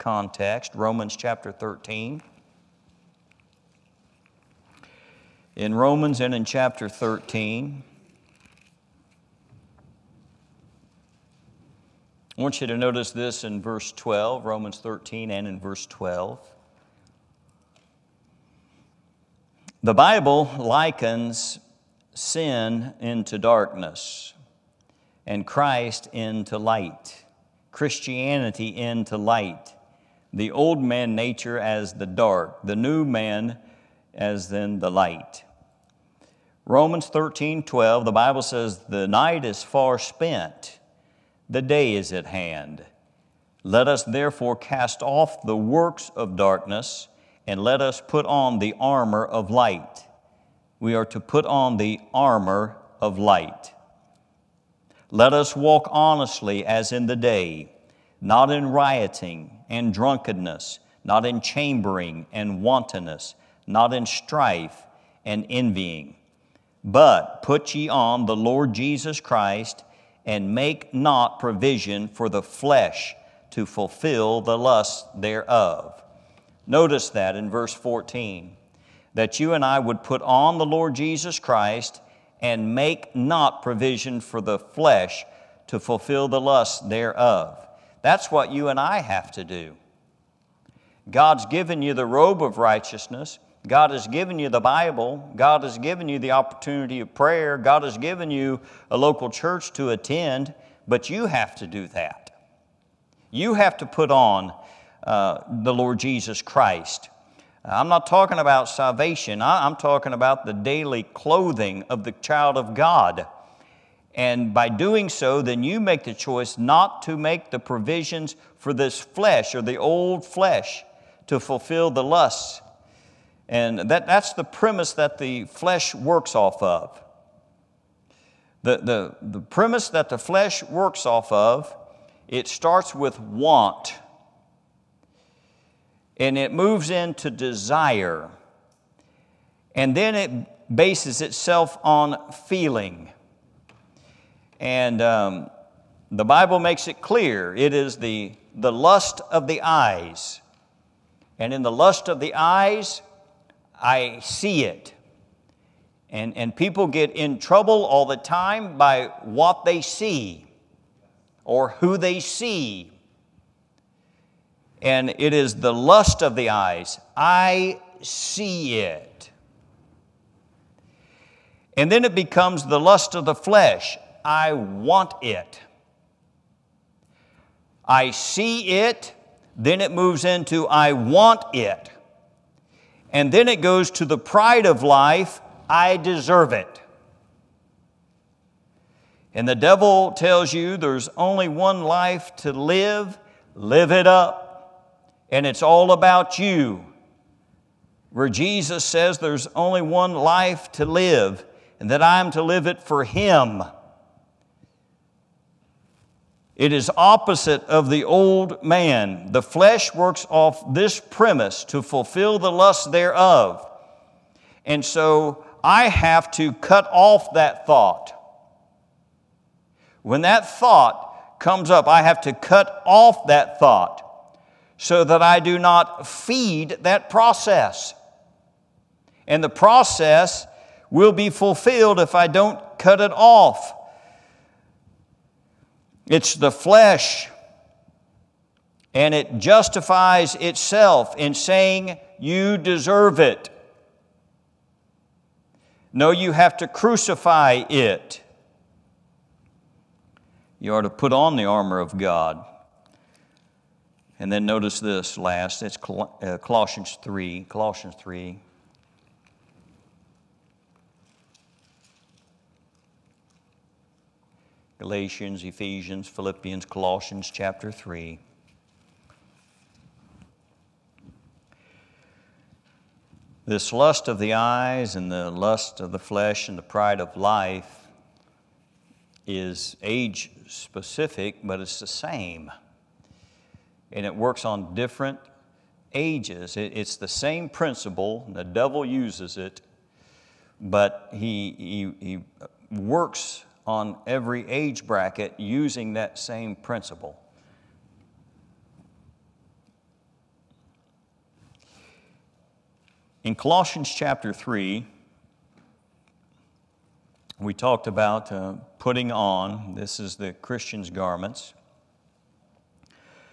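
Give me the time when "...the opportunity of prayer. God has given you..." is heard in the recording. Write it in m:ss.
1:36.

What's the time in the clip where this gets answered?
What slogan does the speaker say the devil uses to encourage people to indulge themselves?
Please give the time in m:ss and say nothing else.
3:13.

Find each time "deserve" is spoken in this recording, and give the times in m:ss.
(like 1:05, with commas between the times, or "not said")
3:05, 4:02.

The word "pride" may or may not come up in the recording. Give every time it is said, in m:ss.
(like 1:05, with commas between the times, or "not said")
3:04, 4:36.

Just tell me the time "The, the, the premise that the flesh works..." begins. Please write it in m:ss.
2:08.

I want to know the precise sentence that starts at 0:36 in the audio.
Romans 13 12, the Bible says, The night is far spent, the day is at hand.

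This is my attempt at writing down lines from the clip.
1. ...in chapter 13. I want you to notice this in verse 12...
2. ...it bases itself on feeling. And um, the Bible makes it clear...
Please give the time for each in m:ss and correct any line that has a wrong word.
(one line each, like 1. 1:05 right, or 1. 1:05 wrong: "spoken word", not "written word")
1. 0:06 right
2. 2:20 right.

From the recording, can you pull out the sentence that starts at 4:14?
And then notice this last, it's uh, Colossians 3, Colossians 3, Galatians, Ephesians, Philippians, Colossians chapter 3.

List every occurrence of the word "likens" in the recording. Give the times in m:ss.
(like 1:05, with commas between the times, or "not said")
0:20.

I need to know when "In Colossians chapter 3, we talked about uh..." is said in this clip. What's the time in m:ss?
5:03.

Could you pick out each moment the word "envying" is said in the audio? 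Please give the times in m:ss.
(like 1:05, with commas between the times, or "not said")
1:05.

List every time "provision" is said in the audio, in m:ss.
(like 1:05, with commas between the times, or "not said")
1:11, 1:23, 1:57.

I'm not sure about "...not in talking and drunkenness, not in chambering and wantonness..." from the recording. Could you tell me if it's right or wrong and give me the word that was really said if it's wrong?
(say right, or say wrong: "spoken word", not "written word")
wrong: "rioting", not "talking".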